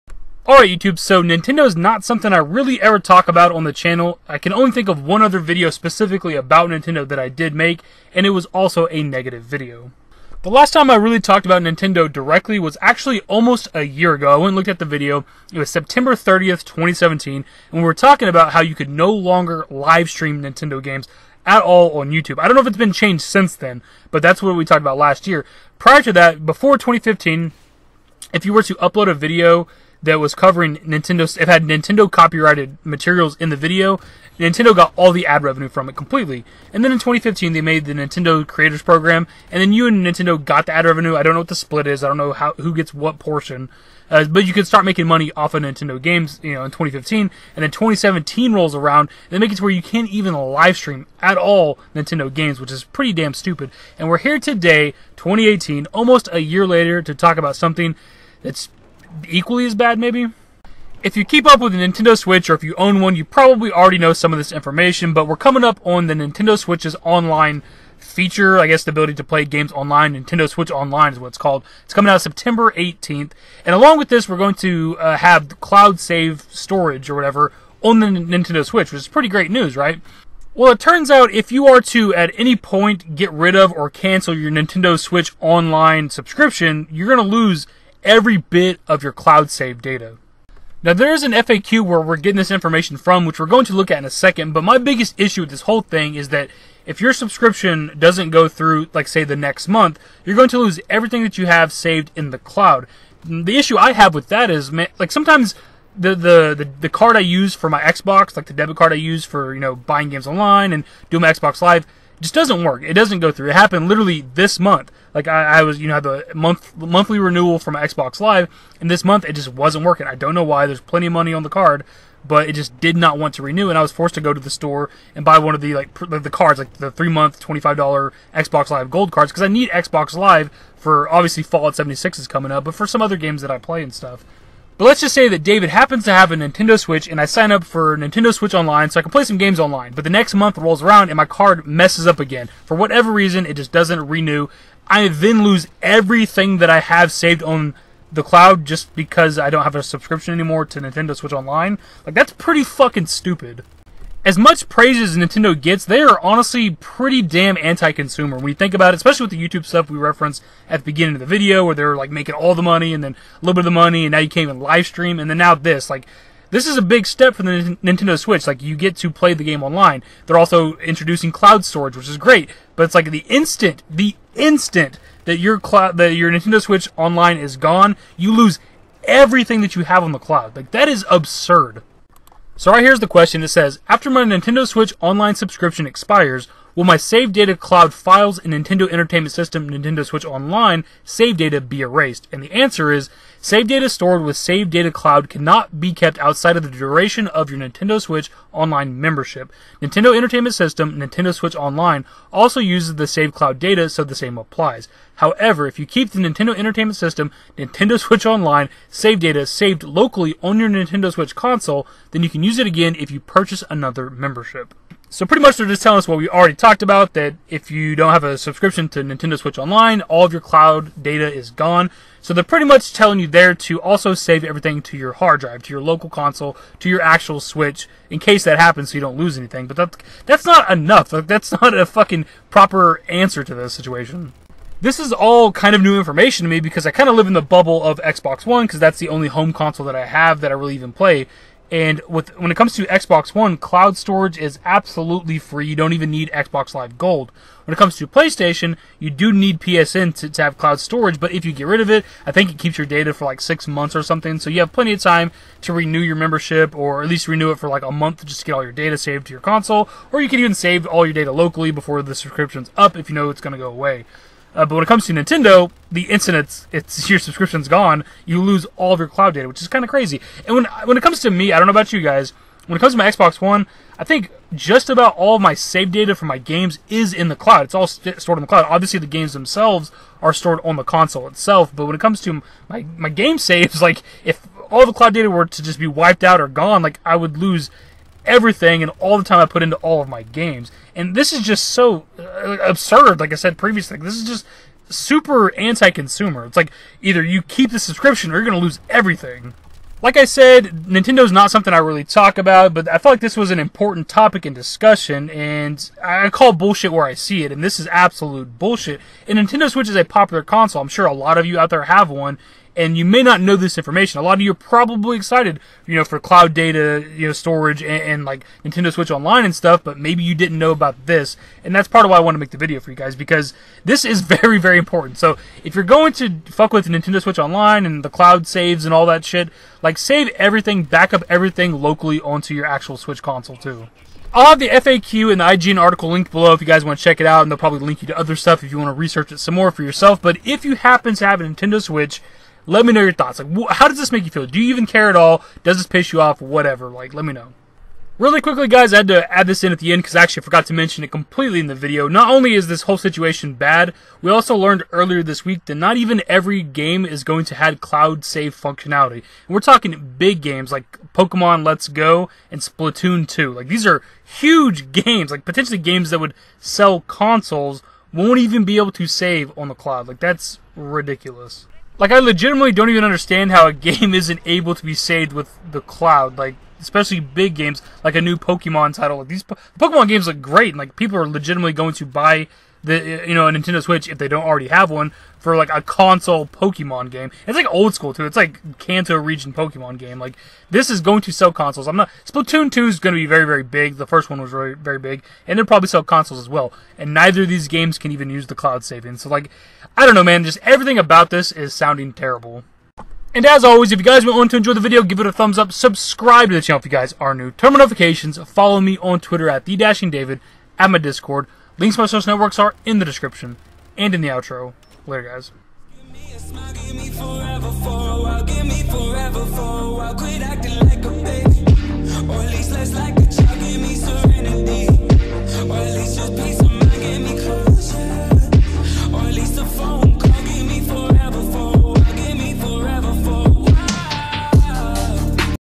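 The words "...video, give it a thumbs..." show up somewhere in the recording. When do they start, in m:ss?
6:44.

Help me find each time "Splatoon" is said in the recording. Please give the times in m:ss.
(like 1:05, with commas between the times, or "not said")
6:02, 6:32.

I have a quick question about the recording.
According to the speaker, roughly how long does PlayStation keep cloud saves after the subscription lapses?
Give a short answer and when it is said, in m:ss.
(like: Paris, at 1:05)
6 months, at 4:13.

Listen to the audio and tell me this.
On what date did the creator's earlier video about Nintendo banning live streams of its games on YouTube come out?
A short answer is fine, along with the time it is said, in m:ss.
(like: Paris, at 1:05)
September 30th, 2017, at 0:15.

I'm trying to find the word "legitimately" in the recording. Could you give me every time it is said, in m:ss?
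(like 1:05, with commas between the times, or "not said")
6:12, 6:21.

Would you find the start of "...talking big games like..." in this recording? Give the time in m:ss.
5:59.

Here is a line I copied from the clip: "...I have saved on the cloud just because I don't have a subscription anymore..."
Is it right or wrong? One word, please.
right.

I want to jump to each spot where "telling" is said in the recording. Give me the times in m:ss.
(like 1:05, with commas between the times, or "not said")
3:35, 3:42.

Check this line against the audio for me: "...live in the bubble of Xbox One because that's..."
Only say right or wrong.
right.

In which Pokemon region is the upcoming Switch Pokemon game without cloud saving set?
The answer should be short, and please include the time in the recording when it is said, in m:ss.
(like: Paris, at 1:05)
Kanto, at 6:28.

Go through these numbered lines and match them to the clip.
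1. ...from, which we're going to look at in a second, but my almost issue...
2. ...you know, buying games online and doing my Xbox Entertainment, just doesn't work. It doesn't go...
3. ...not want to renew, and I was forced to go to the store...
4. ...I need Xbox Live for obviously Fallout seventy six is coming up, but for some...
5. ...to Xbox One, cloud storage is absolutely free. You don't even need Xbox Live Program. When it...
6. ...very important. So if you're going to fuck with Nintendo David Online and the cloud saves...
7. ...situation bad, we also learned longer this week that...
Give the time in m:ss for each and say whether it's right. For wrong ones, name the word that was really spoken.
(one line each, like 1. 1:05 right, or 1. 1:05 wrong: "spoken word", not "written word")
1. 1:32 wrong: "biggest", not "almost"
2. 1:49 wrong: "Live", not "Entertainment"
3. 2:02 right
4. 2:09 right
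5. 4:02 wrong: "Gold", not "Program"
6. 5:24 wrong: "Switch", not "David"
7. 5:52 wrong: "earlier", not "longer".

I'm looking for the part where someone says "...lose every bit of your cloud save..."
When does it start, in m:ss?
1:27.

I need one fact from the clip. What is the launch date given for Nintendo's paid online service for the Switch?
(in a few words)
September 18th.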